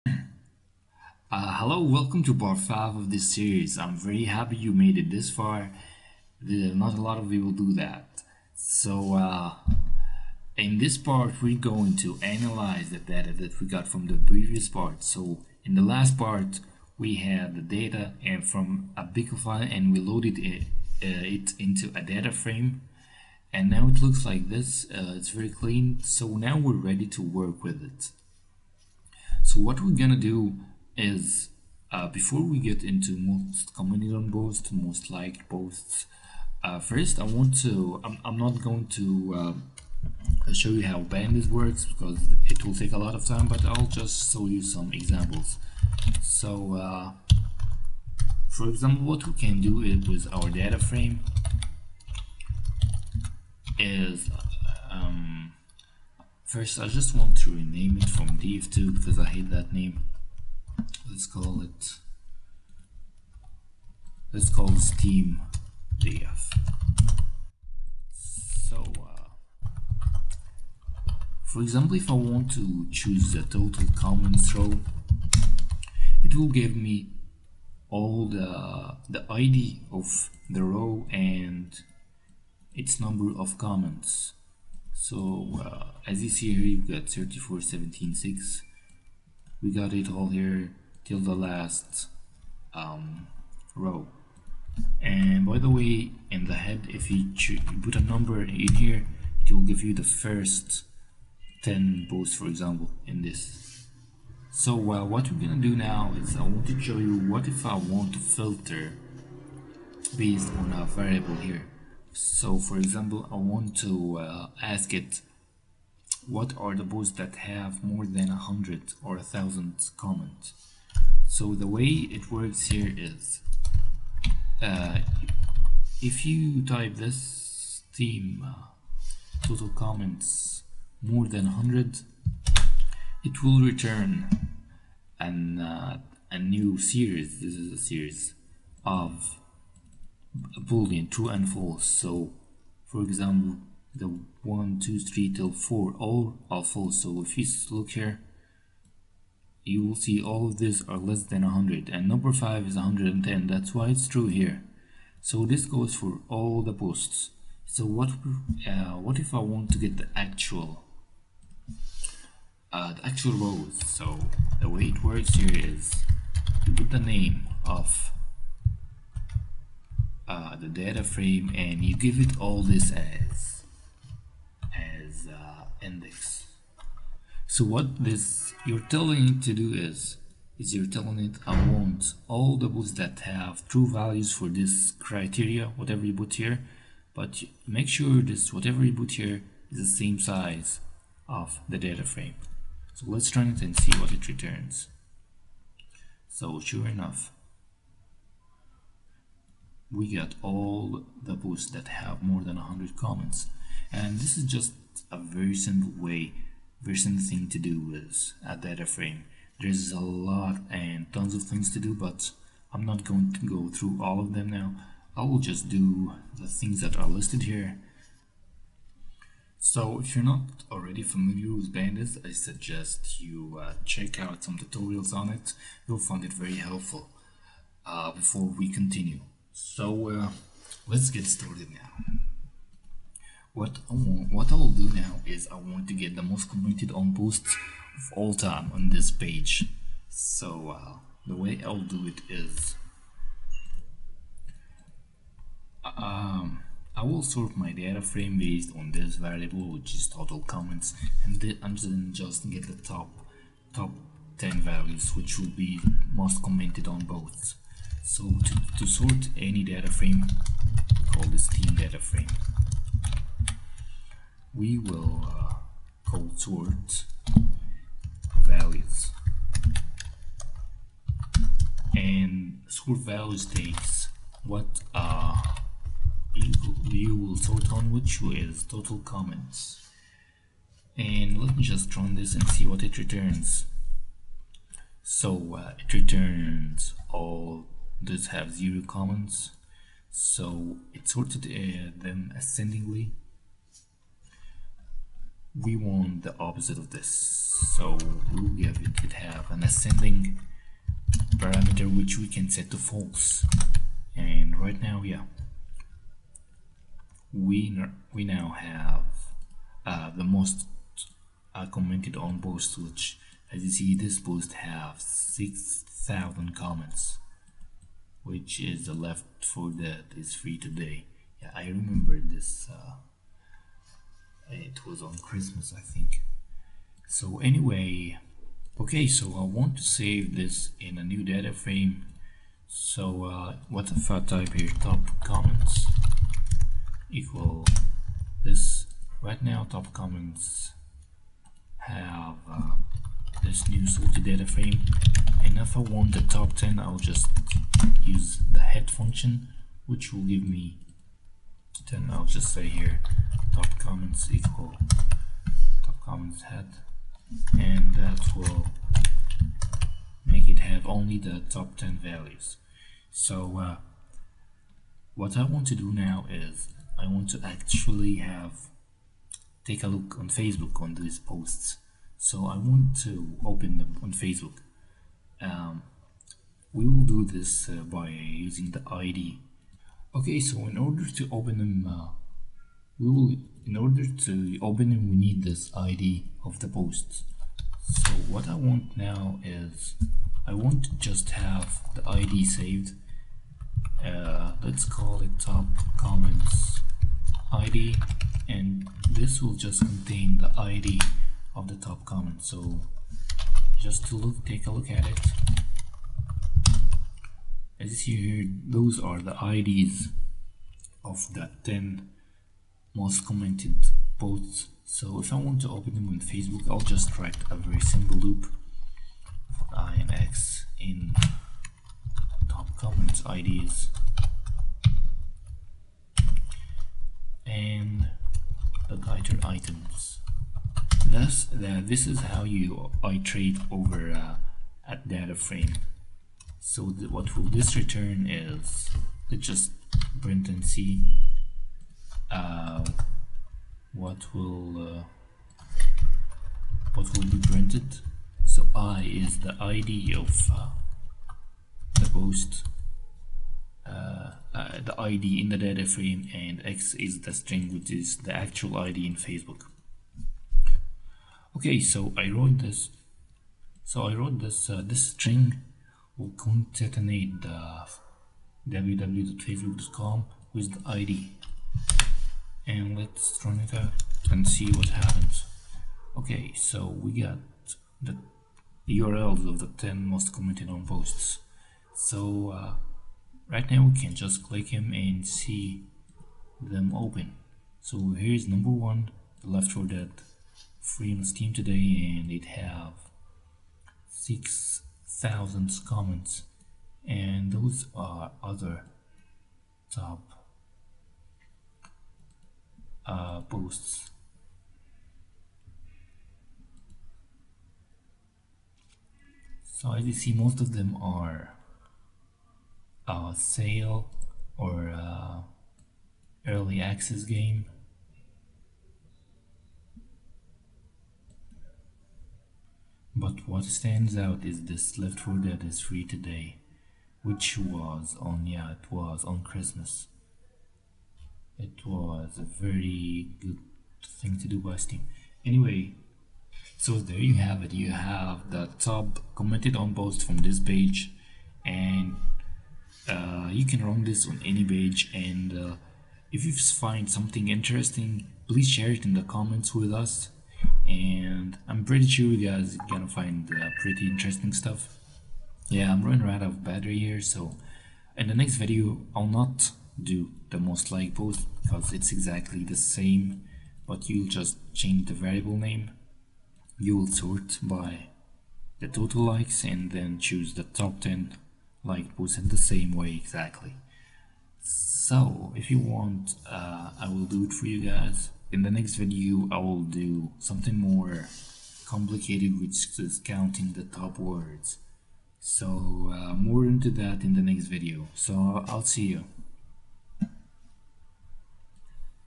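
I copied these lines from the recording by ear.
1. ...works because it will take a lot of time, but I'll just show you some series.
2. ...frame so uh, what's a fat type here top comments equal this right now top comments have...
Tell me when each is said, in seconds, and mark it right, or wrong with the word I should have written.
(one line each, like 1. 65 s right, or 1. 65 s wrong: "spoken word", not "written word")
1. 41 s wrong: "examples", not "series"
2. 331 s right.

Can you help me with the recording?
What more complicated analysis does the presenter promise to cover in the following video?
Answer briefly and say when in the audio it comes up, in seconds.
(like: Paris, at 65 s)
counting the top words, at 583 s.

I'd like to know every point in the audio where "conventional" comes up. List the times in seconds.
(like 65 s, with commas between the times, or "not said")
not said.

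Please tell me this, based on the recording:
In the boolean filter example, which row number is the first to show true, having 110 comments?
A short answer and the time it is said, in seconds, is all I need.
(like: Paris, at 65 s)
5, at 152 s.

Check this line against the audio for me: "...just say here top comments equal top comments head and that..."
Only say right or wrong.
right.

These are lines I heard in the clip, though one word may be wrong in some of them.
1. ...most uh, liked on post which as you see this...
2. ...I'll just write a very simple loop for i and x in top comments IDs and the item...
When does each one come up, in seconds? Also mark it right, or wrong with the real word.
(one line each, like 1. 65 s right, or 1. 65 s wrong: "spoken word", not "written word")
1. 310 s wrong: "commented", not "liked"
2. 416 s right.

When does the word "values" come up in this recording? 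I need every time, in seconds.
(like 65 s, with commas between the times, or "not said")
183 s, 254 s, 268 s, 272 s, 362 s.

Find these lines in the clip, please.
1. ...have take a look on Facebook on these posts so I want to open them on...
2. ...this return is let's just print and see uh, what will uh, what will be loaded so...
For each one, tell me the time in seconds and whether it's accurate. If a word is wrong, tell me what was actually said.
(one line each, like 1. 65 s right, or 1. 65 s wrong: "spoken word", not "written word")
1. 368 s right
2. 437 s wrong: "printed", not "loaded".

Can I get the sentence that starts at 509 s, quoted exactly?
So as you see, most of them are a uh, sale or a uh, early access game.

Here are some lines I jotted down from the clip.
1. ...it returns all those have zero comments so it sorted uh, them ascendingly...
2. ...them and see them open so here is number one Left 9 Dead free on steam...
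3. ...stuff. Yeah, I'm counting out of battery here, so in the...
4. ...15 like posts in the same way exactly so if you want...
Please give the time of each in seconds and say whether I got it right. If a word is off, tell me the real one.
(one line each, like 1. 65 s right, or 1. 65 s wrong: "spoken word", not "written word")
1. 285 s right
2. 484 s wrong: "4", not "9"
3. 554 s wrong: "running", not "counting"
4. 571 s wrong: "10", not "15".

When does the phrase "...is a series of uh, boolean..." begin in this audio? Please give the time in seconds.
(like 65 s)
137 s.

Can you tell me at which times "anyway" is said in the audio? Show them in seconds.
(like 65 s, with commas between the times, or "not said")
327 s, 535 s.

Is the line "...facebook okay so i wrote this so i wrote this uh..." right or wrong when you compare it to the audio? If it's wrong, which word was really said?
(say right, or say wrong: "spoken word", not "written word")
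right.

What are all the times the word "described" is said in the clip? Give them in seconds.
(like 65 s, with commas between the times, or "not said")
not said.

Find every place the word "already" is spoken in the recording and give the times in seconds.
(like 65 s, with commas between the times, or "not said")
220 s.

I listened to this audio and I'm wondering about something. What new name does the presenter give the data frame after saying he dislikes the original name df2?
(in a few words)
Steam df.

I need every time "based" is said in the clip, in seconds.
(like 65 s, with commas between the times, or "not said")
110 s, 248 s.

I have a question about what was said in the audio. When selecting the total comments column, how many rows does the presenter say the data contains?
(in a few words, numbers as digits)
34176.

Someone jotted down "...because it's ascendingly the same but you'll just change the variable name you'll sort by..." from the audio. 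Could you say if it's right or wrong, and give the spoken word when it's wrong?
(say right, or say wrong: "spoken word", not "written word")
wrong: "exactly", not "ascendingly".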